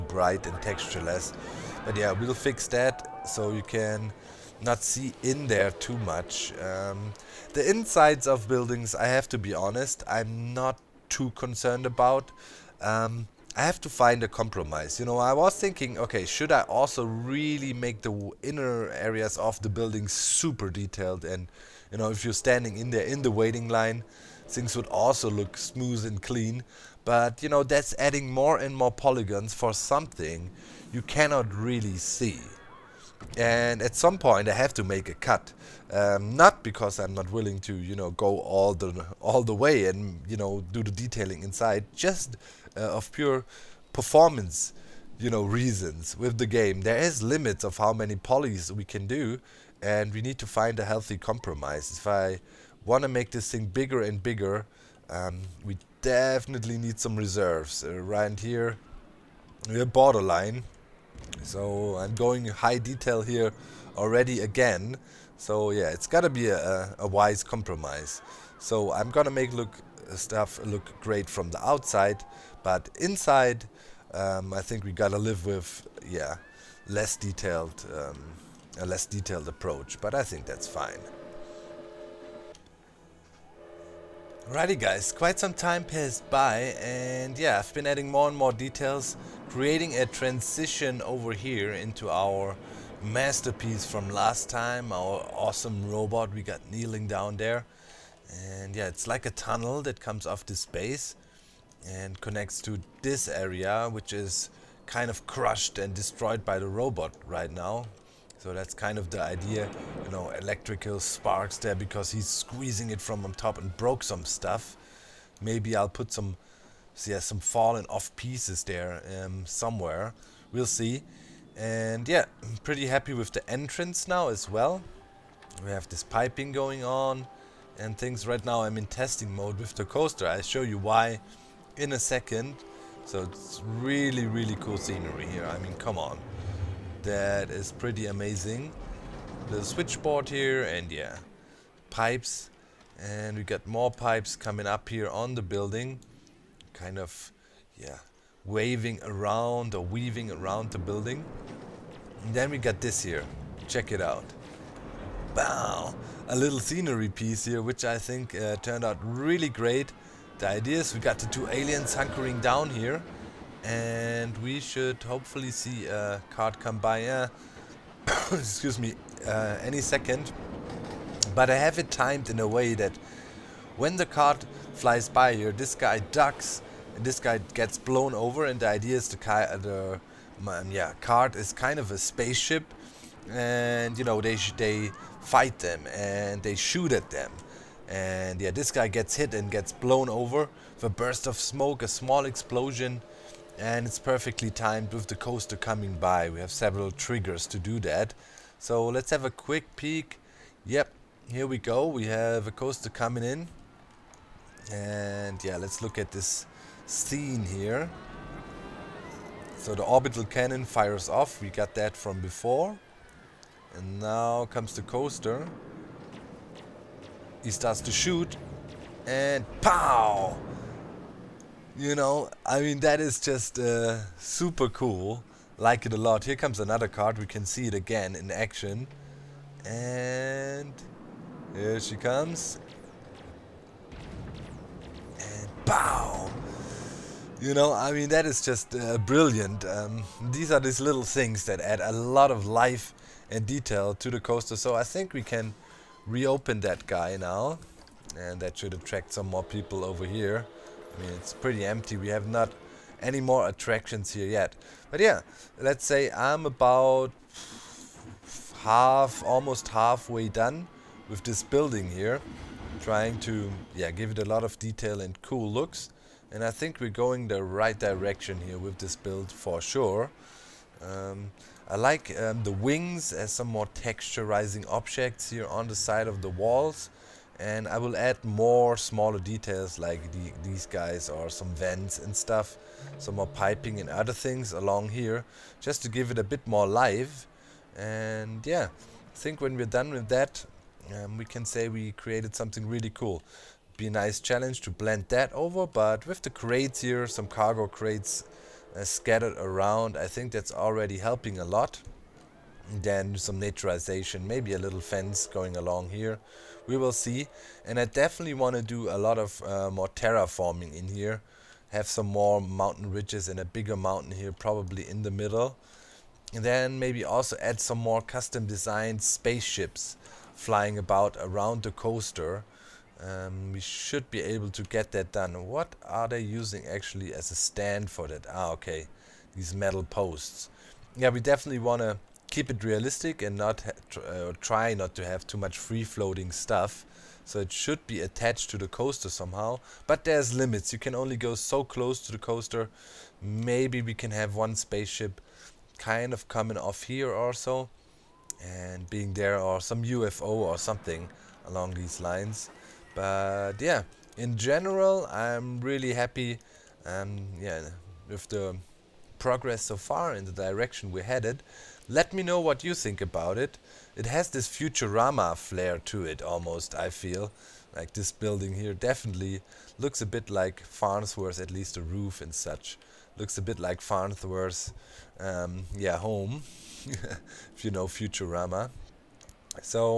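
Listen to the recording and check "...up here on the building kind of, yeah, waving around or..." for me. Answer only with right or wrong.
right.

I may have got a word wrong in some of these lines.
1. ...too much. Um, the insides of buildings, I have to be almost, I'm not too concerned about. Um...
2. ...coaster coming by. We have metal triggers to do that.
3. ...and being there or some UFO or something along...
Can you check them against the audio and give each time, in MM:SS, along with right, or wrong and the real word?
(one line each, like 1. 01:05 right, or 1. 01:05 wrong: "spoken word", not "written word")
1. 00:05 wrong: "honest", not "almost"
2. 03:15 wrong: "several", not "metal"
3. 05:48 right.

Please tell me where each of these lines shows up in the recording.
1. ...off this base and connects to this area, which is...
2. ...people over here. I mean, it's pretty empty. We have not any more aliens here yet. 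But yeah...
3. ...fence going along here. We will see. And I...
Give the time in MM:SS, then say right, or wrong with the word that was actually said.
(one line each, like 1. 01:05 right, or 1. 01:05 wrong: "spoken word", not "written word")
1. 01:40 right
2. 04:09 wrong: "attractions", not "aliens"
3. 05:04 right.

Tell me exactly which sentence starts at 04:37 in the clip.
And I will add more smaller details like the, these guys or some vents and stuff.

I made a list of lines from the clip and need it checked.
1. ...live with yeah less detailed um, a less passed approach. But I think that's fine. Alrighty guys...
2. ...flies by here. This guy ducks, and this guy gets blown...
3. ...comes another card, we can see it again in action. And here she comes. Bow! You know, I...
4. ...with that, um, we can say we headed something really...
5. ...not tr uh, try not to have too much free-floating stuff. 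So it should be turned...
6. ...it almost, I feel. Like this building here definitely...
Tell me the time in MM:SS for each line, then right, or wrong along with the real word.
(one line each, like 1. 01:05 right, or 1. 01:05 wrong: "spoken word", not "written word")
1. 01:15 wrong: "detailed", not "passed"
2. 02:54 right
3. 03:46 right
4. 04:49 wrong: "created", not "headed"
5. 05:33 wrong: "attached", not "turned"
6. 06:06 right.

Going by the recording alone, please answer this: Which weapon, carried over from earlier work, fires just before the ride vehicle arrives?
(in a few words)
orbital cannon.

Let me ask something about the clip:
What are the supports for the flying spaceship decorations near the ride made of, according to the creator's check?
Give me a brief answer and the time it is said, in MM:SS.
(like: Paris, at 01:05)
metal posts, at 05:29.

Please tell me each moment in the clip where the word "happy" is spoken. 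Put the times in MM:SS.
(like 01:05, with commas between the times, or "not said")
02:02, 05:55.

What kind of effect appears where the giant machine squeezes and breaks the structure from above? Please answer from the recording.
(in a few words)
electrical sparks.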